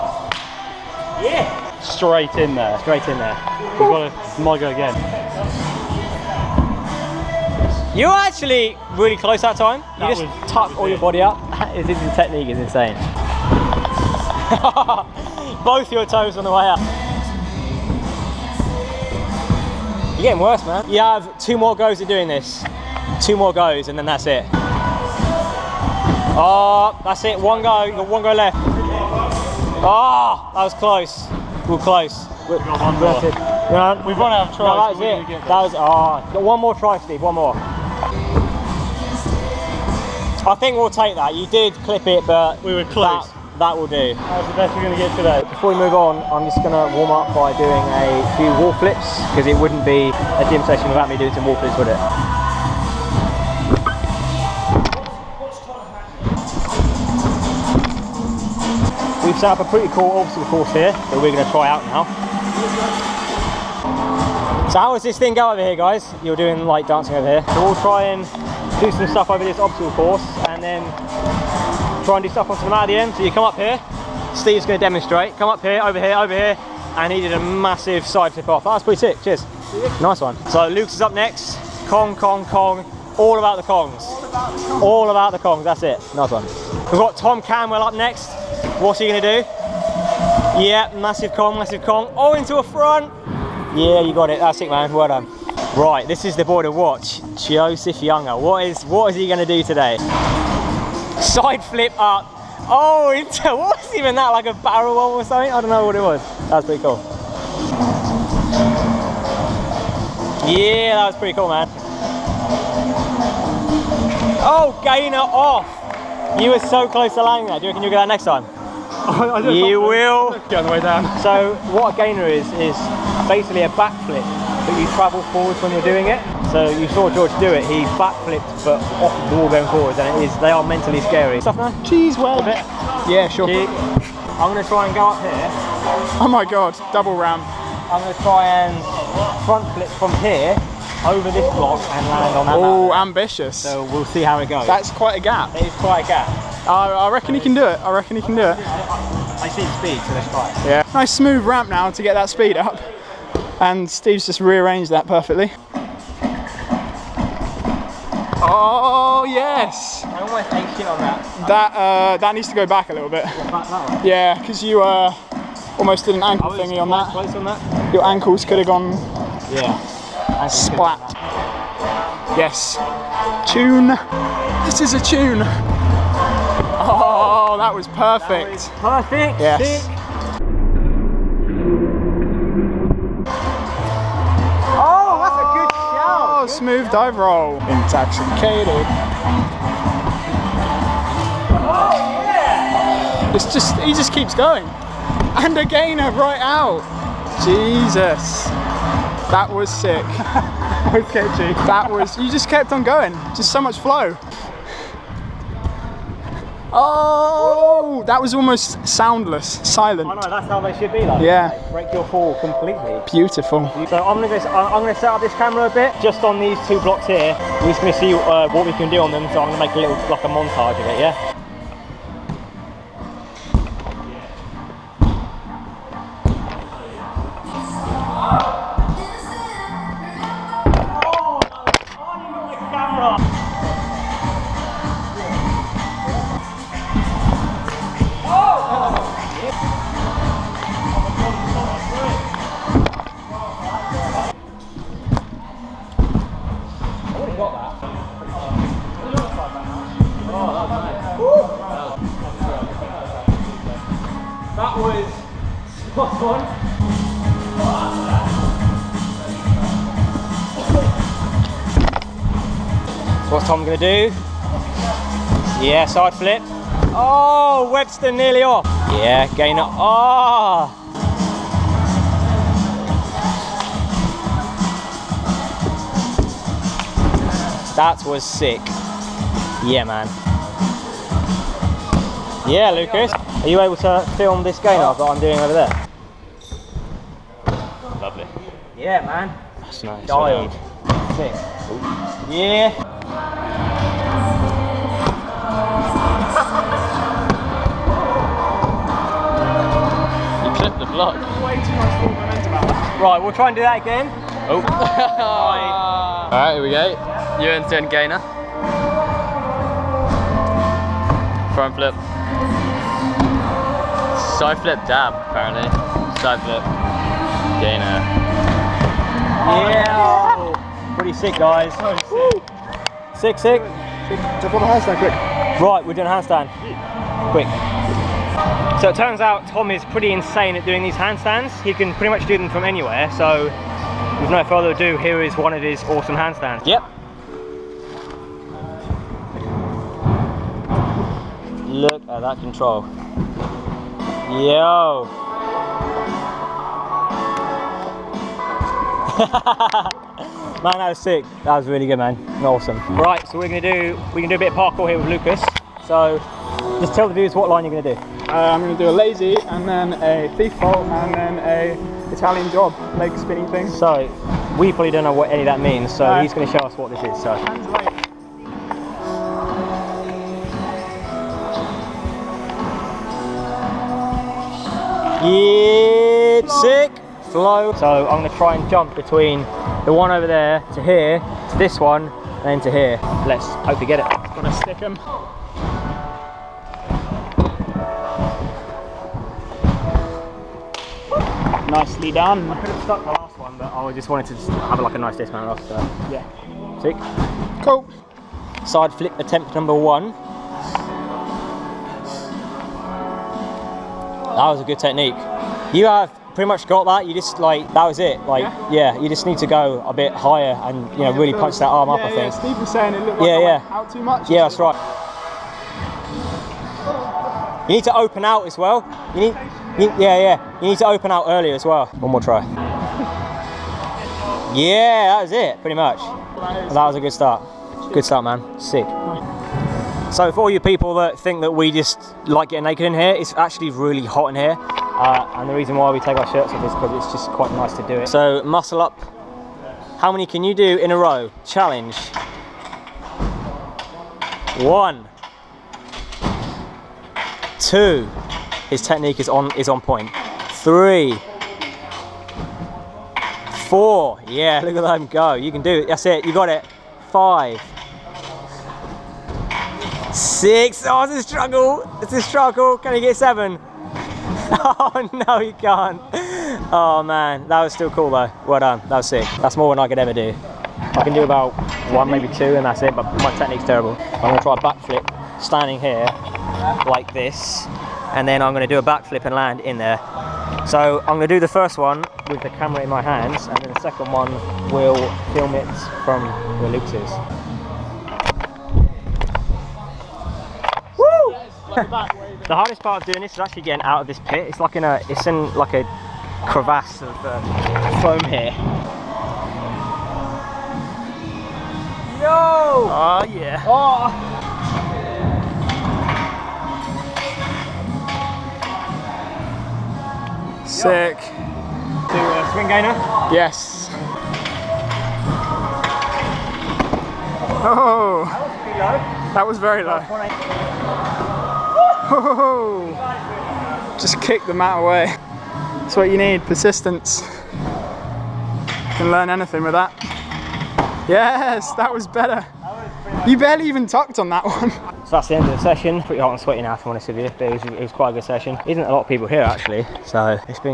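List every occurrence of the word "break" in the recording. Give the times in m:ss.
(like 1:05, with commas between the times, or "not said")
3:31.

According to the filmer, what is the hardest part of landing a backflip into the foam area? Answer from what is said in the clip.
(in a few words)
getting out of this pit.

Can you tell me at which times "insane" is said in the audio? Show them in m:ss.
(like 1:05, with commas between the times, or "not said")
0:12, 5:30.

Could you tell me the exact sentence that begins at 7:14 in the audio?
Uh, and the reason why we take our shirts off is because it's just quite nice to do it.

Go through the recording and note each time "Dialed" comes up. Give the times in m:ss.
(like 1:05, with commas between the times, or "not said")
4:50.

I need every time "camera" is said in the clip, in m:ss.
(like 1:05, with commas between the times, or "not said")
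3:35, 8:02.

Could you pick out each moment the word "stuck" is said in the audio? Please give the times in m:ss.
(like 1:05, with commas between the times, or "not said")
6:32.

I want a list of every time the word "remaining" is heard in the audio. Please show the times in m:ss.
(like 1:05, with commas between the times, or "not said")
not said.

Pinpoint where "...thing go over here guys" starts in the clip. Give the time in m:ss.
1:05.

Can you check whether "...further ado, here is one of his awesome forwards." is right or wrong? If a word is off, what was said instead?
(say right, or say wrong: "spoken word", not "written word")
wrong: "handstands", not "forwards".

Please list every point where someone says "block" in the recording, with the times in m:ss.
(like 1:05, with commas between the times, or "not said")
2:21, 3:36, 5:00.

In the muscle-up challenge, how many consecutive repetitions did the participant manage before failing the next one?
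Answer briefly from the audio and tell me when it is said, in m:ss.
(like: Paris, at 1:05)
6, at 7:40.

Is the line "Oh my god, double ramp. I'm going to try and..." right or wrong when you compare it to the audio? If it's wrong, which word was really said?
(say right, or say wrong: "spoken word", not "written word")
right.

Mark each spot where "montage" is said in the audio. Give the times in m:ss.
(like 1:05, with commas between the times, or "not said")
3:40.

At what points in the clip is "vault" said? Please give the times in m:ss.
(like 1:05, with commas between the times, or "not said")
6:00.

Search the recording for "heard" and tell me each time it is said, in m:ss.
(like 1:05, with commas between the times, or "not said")
not said.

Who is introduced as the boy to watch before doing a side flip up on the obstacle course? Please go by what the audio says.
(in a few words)
Joseph Younger.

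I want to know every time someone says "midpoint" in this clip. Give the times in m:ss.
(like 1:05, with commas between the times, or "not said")
not said.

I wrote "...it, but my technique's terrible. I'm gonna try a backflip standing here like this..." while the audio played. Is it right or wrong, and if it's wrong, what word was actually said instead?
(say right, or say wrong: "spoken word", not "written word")
right.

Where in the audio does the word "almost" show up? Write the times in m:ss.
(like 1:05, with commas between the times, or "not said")
2:40, 2:45, 3:28.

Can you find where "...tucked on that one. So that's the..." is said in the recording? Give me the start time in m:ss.
8:53.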